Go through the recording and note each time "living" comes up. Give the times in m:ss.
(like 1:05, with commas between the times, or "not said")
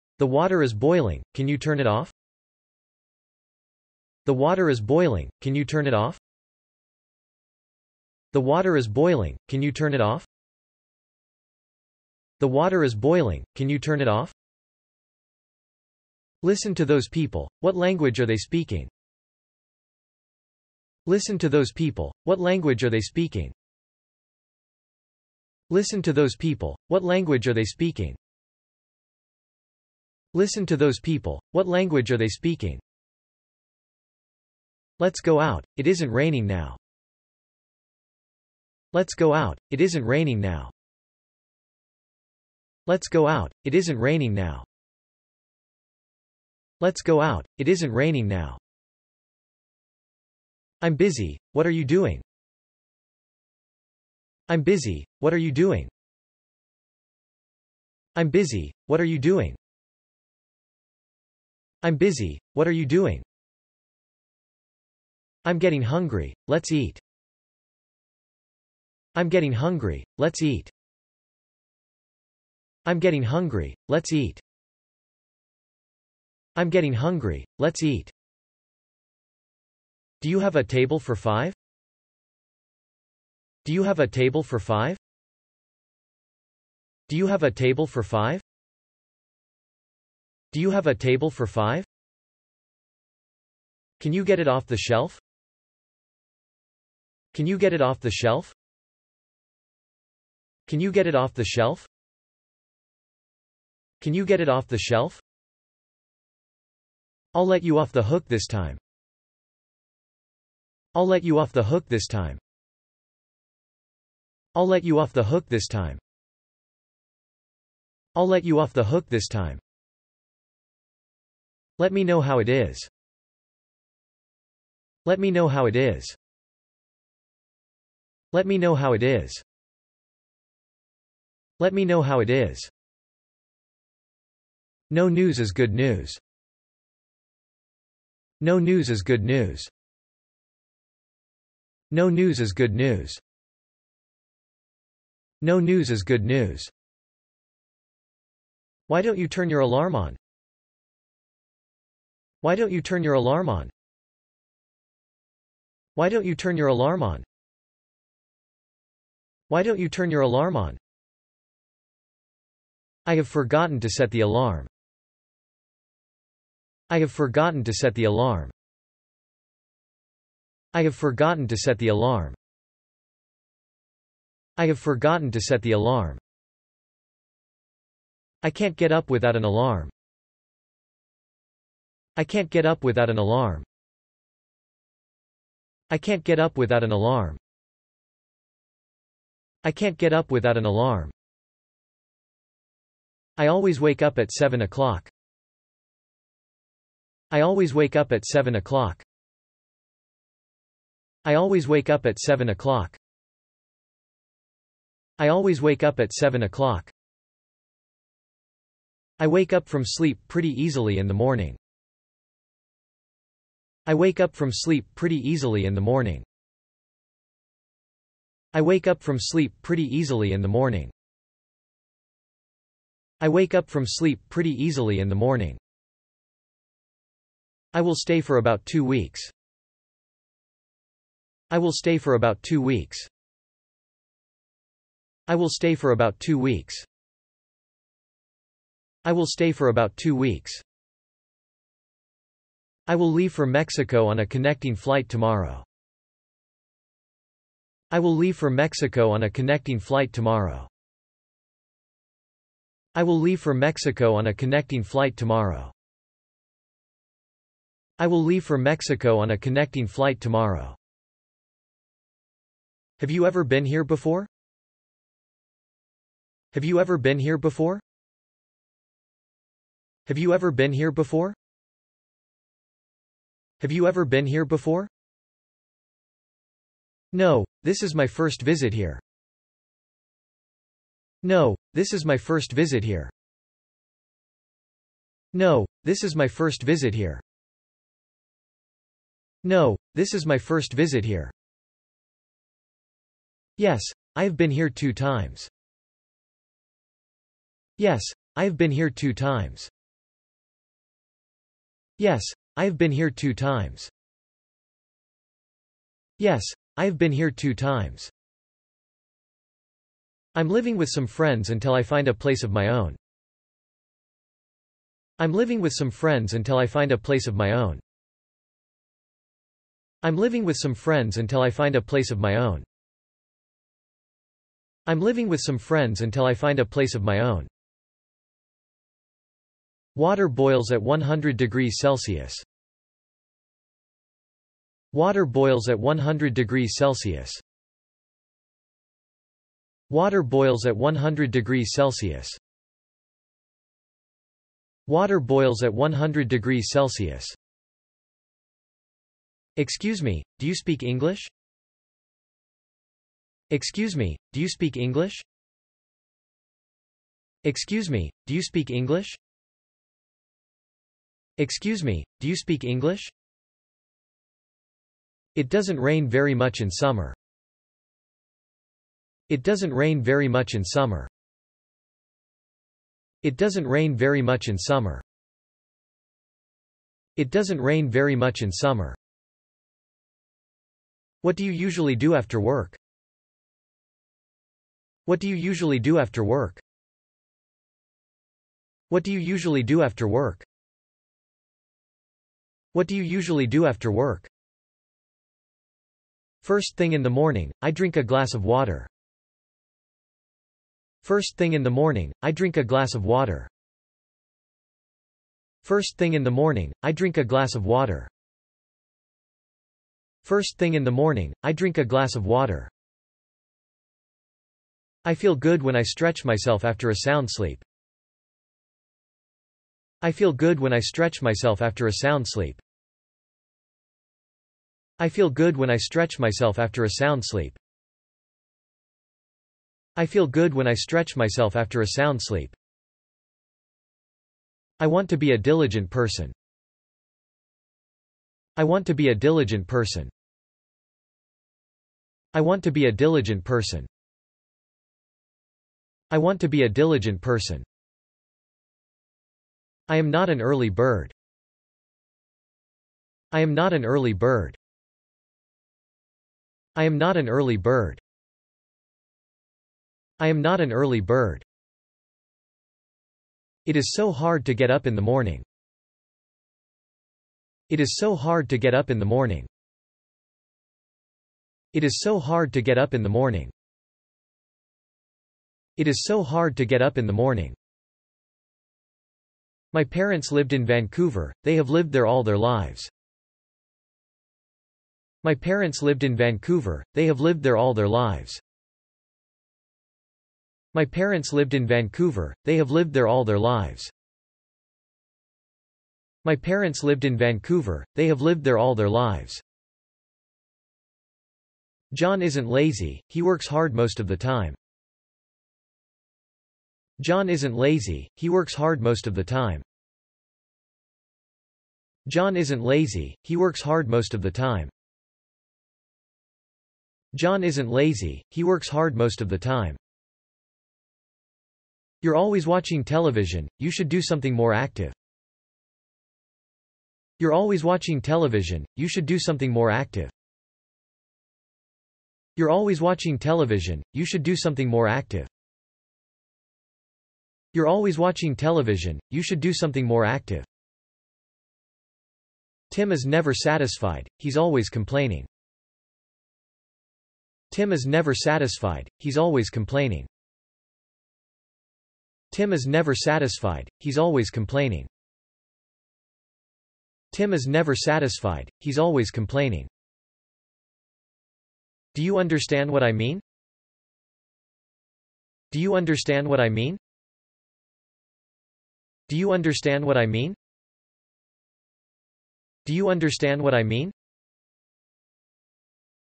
5:10, 5:15, 5:20, 5:24.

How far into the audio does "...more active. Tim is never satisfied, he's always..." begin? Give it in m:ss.
8:59.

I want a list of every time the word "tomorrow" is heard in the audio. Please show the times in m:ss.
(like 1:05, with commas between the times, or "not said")
4:05, 4:10, 4:15, 4:20.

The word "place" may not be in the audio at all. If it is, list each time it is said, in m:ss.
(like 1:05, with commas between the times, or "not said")
5:12, 5:16, 5:21, 5:26.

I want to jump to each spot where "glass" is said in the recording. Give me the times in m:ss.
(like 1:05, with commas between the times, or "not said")
6:38, 6:42, 6:47, 6:51.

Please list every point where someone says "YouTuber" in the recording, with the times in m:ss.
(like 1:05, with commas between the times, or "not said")
not said.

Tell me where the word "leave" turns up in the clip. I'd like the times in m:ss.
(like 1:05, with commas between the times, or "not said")
4:03, 4:08, 4:13, 4:18.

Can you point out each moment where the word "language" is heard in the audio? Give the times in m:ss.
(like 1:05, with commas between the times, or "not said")
0:17, 0:22, 0:27, 0:31.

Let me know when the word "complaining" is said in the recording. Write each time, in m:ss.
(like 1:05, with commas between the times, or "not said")
9:04, 9:09, 9:14, 9:19.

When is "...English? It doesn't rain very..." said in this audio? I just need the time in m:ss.
6:02.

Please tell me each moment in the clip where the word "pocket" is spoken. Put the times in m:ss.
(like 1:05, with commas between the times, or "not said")
not said.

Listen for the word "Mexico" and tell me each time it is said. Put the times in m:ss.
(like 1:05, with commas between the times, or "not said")
4:03, 4:08, 4:13, 4:18.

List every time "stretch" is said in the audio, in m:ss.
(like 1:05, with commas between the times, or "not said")
6:55, 7:00, 7:05, 7:10.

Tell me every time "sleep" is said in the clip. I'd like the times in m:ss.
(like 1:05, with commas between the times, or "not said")
3:29, 3:34, 3:39, 3:43, 6:57, 7:02, 7:07, 7:12.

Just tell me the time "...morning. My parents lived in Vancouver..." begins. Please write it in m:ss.
7:57.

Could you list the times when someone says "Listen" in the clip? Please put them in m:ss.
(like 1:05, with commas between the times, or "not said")
0:16, 0:21, 0:25, 0:30.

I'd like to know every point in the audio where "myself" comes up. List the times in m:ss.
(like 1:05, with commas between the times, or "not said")
6:56, 7:01, 7:06, 7:11.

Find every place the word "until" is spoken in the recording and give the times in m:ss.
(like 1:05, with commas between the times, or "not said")
5:11, 5:16, 5:21, 5:26.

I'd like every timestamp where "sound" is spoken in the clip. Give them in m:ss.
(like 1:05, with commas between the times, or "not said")
6:56, 7:01, 7:06, 7:11.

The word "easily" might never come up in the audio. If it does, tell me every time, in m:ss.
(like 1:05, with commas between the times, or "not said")
3:30, 3:35, 3:39, 3:44.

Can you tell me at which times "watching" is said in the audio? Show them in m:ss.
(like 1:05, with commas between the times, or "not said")
8:42, 8:47, 8:52, 8:57.